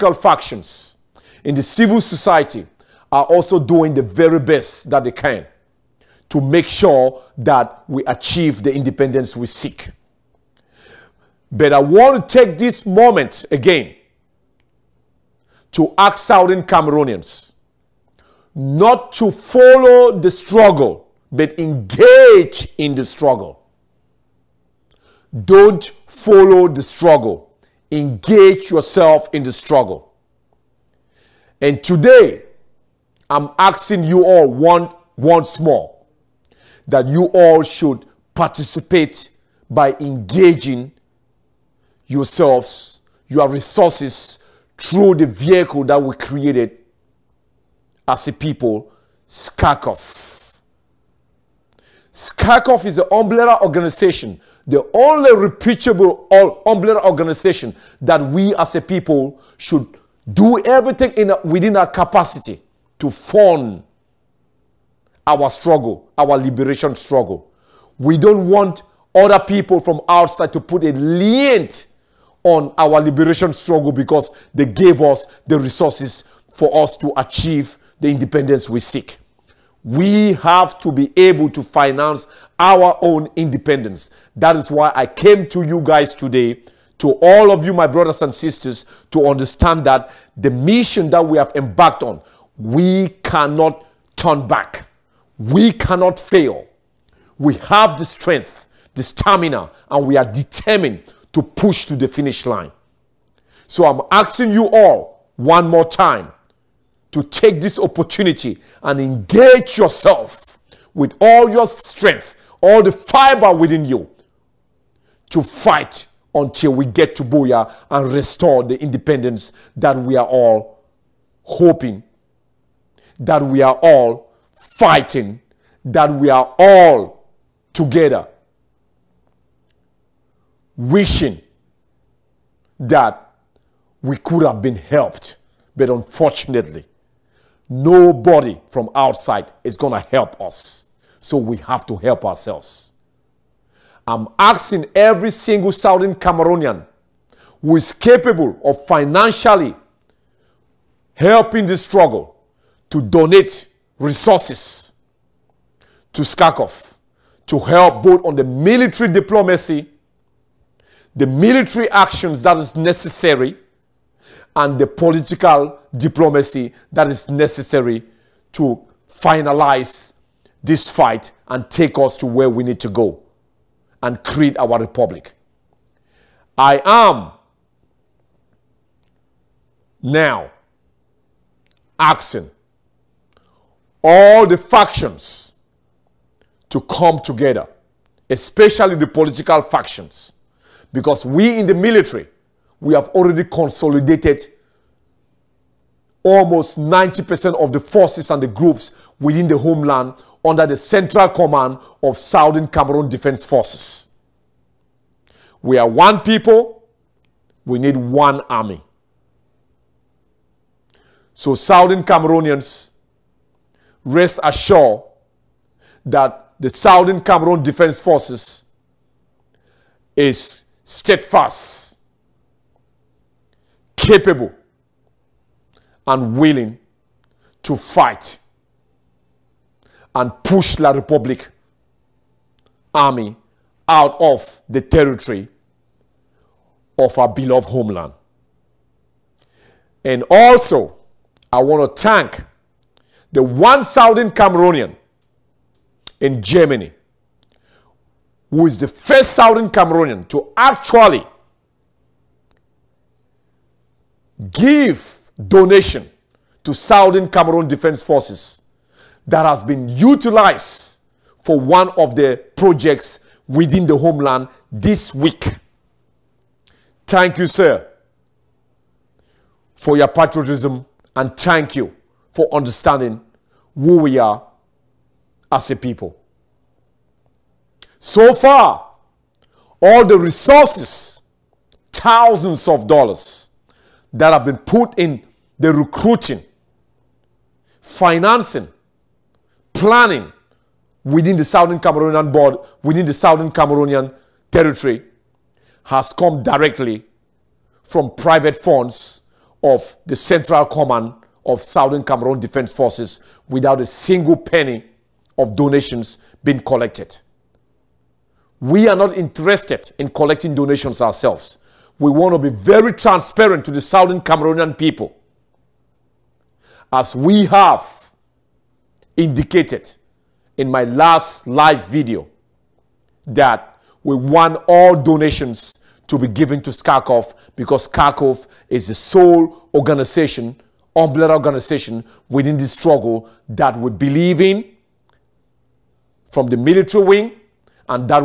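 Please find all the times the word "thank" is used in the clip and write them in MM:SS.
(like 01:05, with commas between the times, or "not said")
04:02, 04:27, 04:31.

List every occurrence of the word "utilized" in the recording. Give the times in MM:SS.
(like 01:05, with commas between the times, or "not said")
04:19.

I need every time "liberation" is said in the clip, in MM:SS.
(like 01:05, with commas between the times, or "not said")
01:06, 01:13.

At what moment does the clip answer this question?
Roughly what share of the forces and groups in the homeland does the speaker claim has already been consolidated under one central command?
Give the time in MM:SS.
03:16.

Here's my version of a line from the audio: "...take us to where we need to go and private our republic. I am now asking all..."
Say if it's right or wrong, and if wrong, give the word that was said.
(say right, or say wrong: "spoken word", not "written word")
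wrong: "create", not "private".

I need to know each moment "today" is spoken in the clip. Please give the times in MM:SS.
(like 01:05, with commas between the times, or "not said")
00:31, 01:26.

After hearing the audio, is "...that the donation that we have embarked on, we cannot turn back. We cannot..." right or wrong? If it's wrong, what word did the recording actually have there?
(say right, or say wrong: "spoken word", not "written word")
wrong: "mission", not "donation".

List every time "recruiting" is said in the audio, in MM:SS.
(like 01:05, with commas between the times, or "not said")
04:45.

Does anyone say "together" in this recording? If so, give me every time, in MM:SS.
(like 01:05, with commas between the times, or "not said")
02:07, 03:07.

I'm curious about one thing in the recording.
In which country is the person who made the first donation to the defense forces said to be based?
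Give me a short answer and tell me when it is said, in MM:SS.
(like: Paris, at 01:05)
Germany, at 04:06.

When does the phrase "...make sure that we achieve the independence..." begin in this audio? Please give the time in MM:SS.
00:06.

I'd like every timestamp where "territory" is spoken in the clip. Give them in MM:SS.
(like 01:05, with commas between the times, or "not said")
03:54, 04:54.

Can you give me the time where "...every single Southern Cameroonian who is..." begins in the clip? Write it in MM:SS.
02:24.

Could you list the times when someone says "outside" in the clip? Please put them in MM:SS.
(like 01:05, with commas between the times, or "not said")
01:10, 02:18.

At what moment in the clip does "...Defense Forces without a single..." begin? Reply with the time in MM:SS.
05:02.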